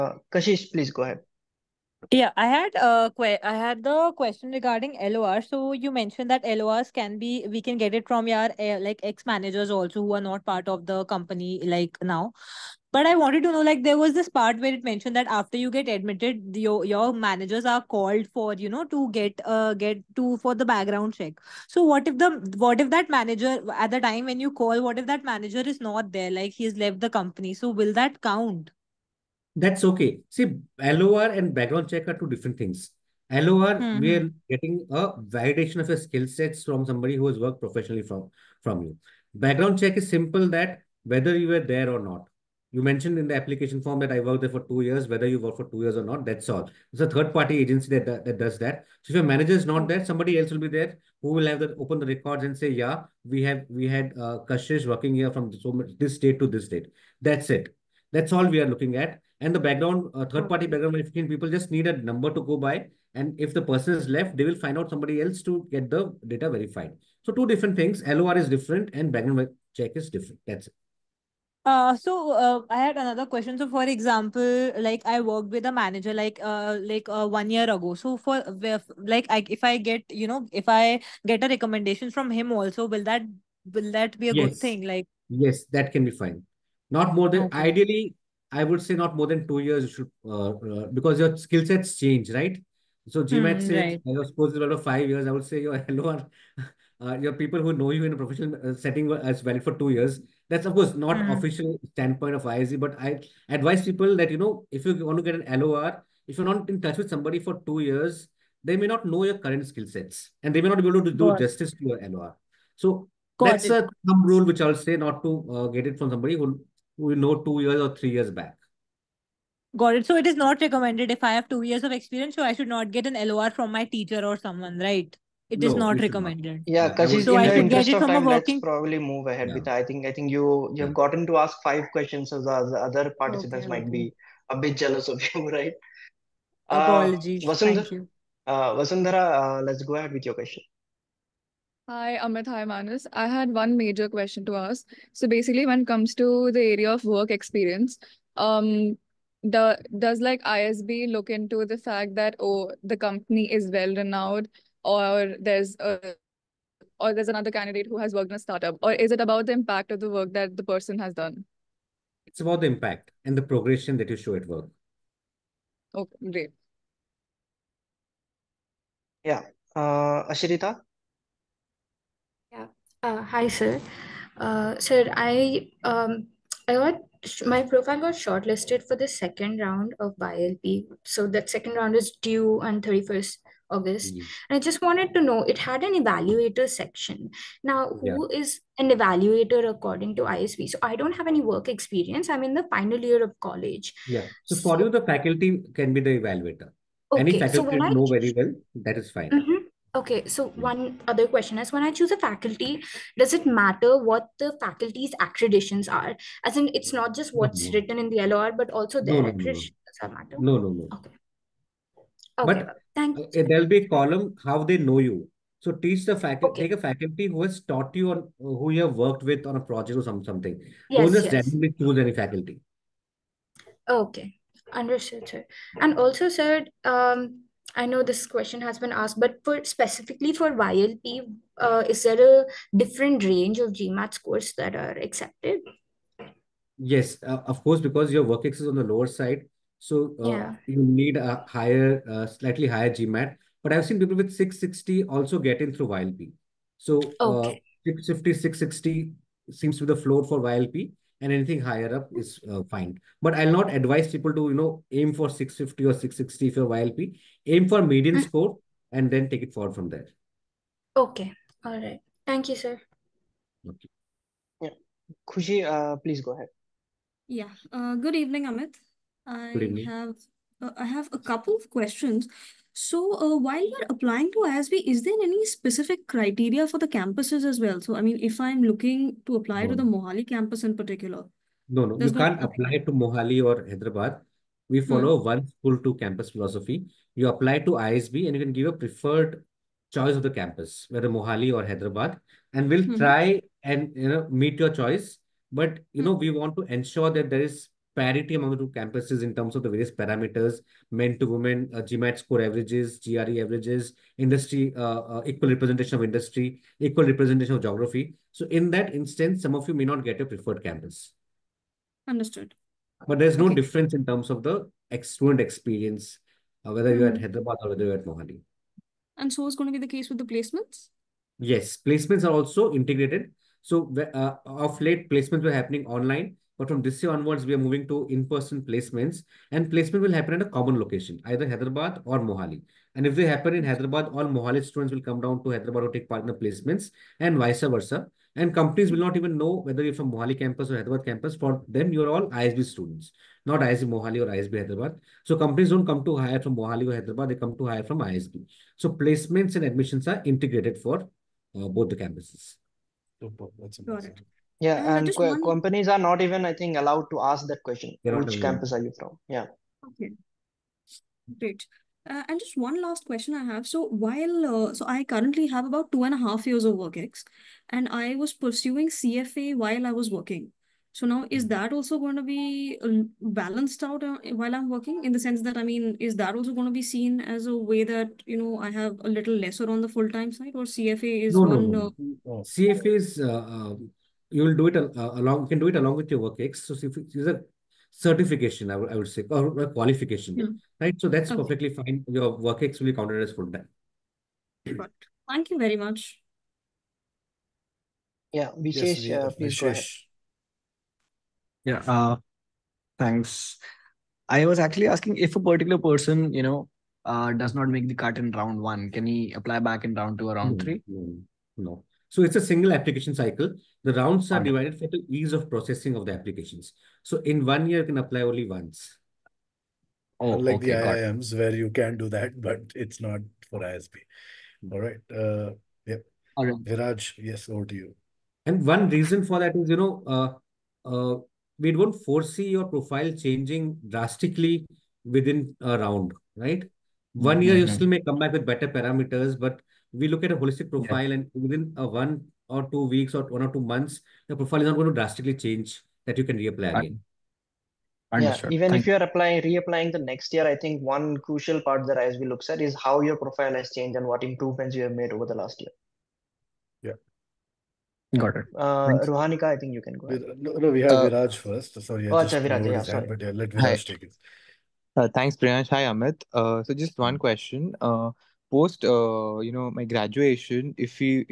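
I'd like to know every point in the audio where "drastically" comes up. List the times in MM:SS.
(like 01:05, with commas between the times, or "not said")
07:13, 07:24.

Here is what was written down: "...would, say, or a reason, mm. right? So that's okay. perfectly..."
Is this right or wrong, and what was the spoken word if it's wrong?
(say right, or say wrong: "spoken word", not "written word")
wrong: "qualification", not "reason".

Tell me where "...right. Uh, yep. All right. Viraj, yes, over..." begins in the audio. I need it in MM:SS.
07:04.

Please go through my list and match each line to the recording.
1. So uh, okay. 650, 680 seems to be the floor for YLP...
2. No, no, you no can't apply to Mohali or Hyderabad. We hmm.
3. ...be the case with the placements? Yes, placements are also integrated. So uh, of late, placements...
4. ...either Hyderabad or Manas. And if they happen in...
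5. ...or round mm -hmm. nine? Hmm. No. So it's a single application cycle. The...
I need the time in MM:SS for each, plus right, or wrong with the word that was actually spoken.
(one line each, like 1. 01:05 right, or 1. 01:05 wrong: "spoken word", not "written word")
1. 04:06 wrong: "660", not "680"
2. 04:41 right
3. 05:19 right
4. 05:31 wrong: "Mohali", not "Manas"
5. 06:50 wrong: "three", not "nine".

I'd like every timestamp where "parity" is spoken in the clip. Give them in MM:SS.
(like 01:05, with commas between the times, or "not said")
04:57.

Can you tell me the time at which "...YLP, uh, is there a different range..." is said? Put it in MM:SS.
03:50.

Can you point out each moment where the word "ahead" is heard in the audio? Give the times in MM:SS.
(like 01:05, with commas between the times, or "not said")
00:01, 02:09, 02:19, 04:26, 06:39, 07:40.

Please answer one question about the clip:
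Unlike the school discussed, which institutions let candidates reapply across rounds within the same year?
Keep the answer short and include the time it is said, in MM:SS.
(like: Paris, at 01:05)
IIMs, at 07:00.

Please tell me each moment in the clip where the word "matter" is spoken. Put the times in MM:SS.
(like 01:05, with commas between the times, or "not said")
03:23, 03:30.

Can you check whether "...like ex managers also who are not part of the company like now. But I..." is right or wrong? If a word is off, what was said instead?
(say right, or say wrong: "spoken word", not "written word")
right.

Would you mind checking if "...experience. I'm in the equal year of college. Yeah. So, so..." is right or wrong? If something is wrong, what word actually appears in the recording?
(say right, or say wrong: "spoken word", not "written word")
wrong: "final", not "equal".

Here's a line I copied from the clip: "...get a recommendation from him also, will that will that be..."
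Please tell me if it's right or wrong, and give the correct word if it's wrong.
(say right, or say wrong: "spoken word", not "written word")
right.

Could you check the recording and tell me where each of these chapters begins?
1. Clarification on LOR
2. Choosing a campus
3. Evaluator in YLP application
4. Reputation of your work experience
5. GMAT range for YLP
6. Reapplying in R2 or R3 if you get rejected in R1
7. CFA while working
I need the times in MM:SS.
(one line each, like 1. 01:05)
1. 01:13
2. 04:32
3. 02:56
4. 02:24
5. 03:51
6. 06:44
7. 06:03.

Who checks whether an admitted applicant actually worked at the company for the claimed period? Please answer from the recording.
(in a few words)
third party agency.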